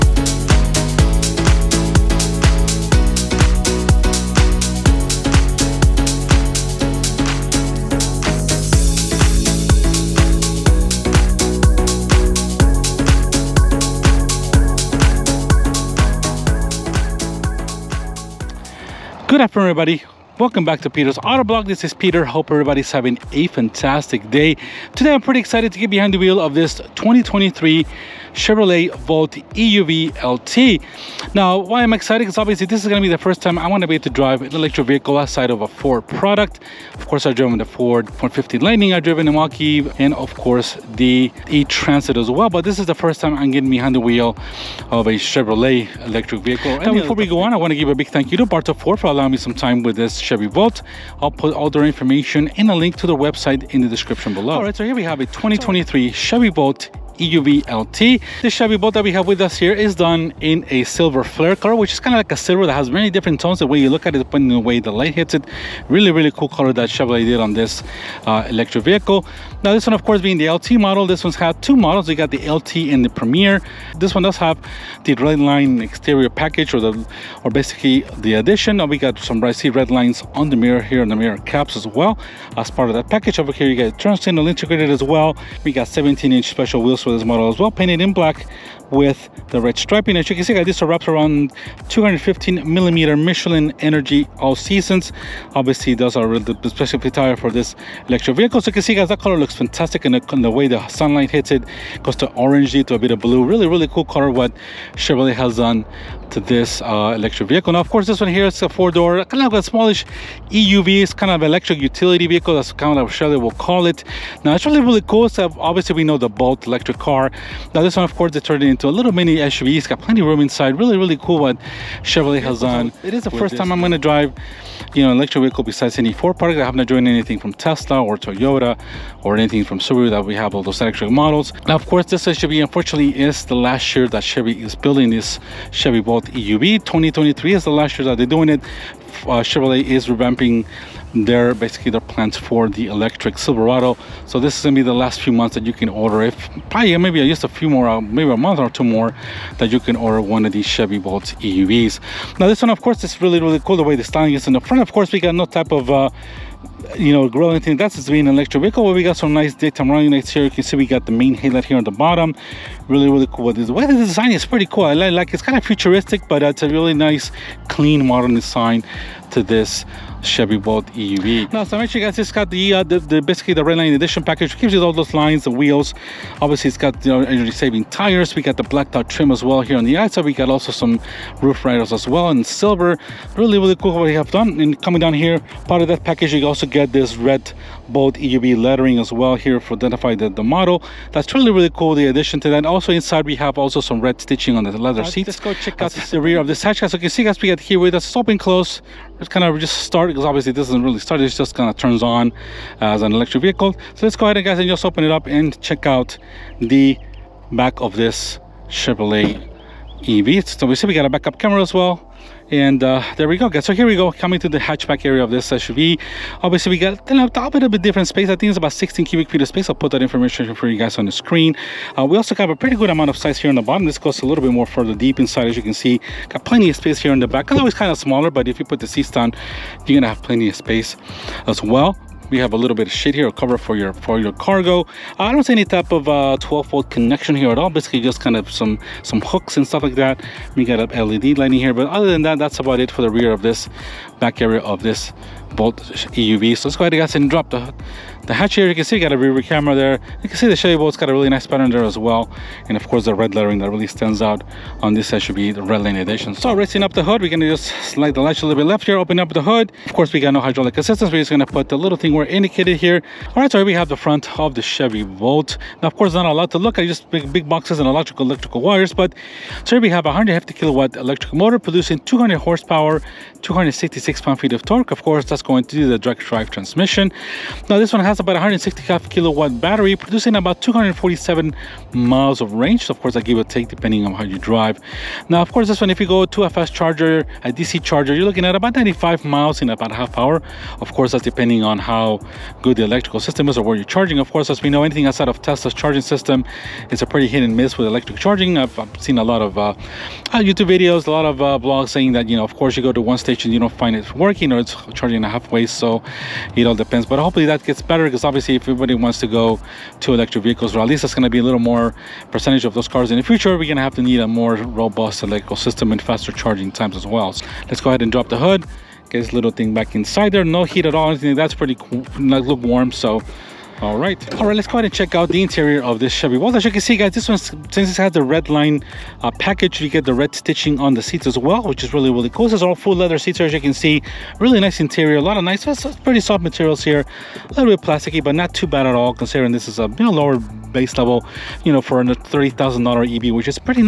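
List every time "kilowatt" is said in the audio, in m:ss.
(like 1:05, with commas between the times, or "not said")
4:30, 4:39.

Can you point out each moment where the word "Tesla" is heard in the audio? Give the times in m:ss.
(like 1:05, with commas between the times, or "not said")
2:07, 4:55.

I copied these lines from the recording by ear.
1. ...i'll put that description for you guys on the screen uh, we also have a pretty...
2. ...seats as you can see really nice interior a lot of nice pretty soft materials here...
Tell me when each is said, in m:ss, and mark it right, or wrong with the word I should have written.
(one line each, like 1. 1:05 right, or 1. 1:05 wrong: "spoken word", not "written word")
1. 3:39 wrong: "information", not "description"
2. 5:33 right.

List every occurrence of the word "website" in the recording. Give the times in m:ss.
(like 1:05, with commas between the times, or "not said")
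0:53.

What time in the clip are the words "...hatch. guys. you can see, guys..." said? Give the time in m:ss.
3:16.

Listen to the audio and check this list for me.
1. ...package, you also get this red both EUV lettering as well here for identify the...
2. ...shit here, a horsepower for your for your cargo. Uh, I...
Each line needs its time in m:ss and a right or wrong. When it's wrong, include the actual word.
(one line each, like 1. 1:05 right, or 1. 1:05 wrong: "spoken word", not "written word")
1. 3:06 right
2. 3:52 wrong: "cover", not "horsepower".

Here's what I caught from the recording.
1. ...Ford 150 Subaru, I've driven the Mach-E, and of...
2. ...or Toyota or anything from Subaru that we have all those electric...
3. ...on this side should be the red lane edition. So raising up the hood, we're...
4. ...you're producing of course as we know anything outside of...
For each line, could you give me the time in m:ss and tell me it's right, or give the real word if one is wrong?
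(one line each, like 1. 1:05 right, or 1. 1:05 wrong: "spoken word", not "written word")
1. 0:37 wrong: "Lightning", not "Subaru"
2. 2:08 right
3. 4:14 right
4. 4:53 wrong: "charging", not "producing".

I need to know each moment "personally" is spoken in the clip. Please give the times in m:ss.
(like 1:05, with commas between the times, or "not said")
not said.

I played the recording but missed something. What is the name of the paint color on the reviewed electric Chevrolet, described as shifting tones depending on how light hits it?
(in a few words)
Silver Flare.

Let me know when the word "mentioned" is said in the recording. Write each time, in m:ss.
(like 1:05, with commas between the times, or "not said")
2:51.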